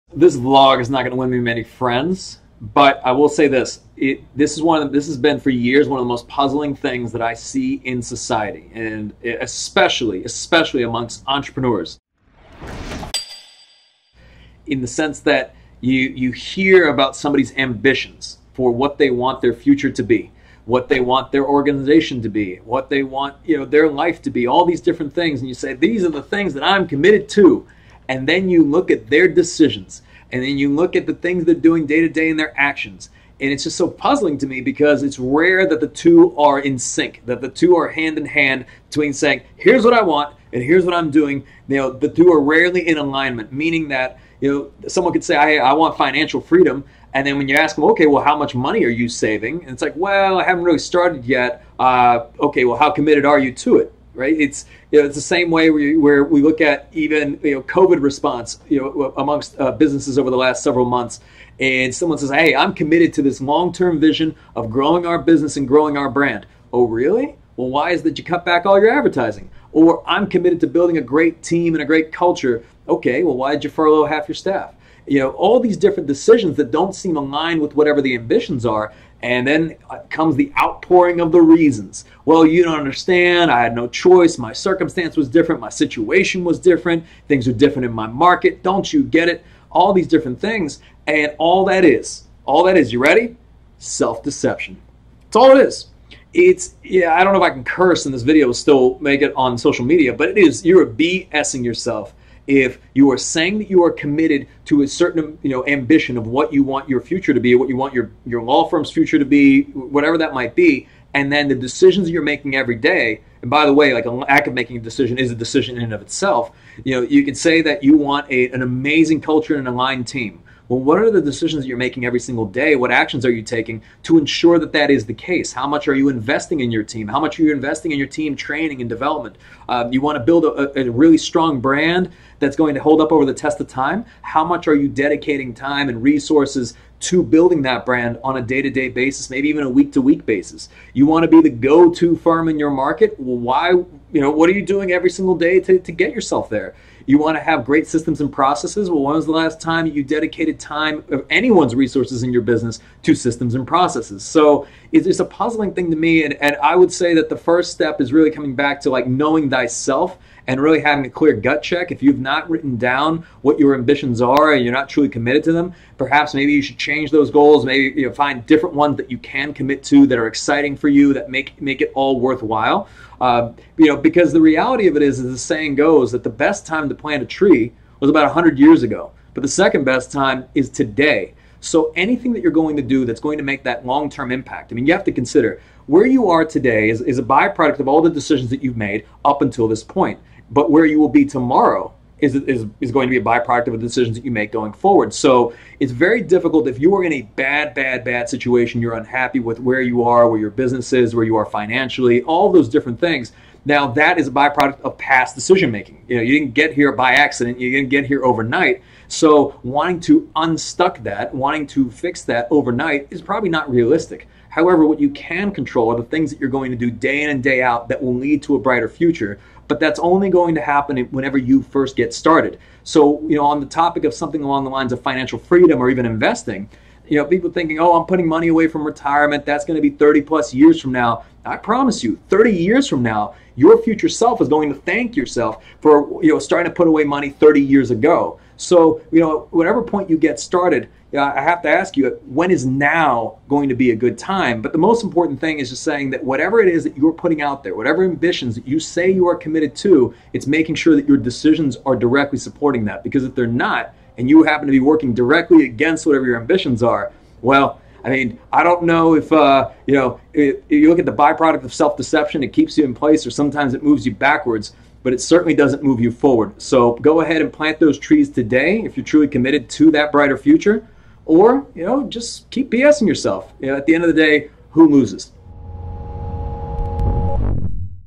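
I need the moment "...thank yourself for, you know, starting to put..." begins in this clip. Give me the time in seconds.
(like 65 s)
234 s.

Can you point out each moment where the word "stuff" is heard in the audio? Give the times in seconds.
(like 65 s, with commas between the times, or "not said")
not said.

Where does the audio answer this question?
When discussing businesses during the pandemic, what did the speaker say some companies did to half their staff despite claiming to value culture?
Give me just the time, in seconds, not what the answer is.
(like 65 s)
73 s.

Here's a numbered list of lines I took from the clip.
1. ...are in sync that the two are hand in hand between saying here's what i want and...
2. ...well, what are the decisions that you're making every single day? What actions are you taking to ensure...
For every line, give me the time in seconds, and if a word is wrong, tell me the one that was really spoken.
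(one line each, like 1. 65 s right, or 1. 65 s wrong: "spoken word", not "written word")
1. 36 s right
2. 120 s right.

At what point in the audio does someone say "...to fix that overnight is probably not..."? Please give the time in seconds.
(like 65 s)
211 s.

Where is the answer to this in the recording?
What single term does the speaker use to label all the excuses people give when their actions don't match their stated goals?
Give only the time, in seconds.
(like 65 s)
93 s.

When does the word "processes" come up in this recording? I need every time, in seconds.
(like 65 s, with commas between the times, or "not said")
148 s, 153 s.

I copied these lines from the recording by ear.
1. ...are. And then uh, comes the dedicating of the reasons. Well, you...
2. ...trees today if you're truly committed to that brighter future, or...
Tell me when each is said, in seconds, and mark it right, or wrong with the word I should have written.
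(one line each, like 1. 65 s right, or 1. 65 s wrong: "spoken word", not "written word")
1. 78 s wrong: "outpouring", not "dedicating"
2. 267 s right.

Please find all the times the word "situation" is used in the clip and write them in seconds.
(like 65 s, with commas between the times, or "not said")
85 s, 198 s.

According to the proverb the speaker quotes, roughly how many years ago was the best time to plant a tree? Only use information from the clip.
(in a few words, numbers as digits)
100.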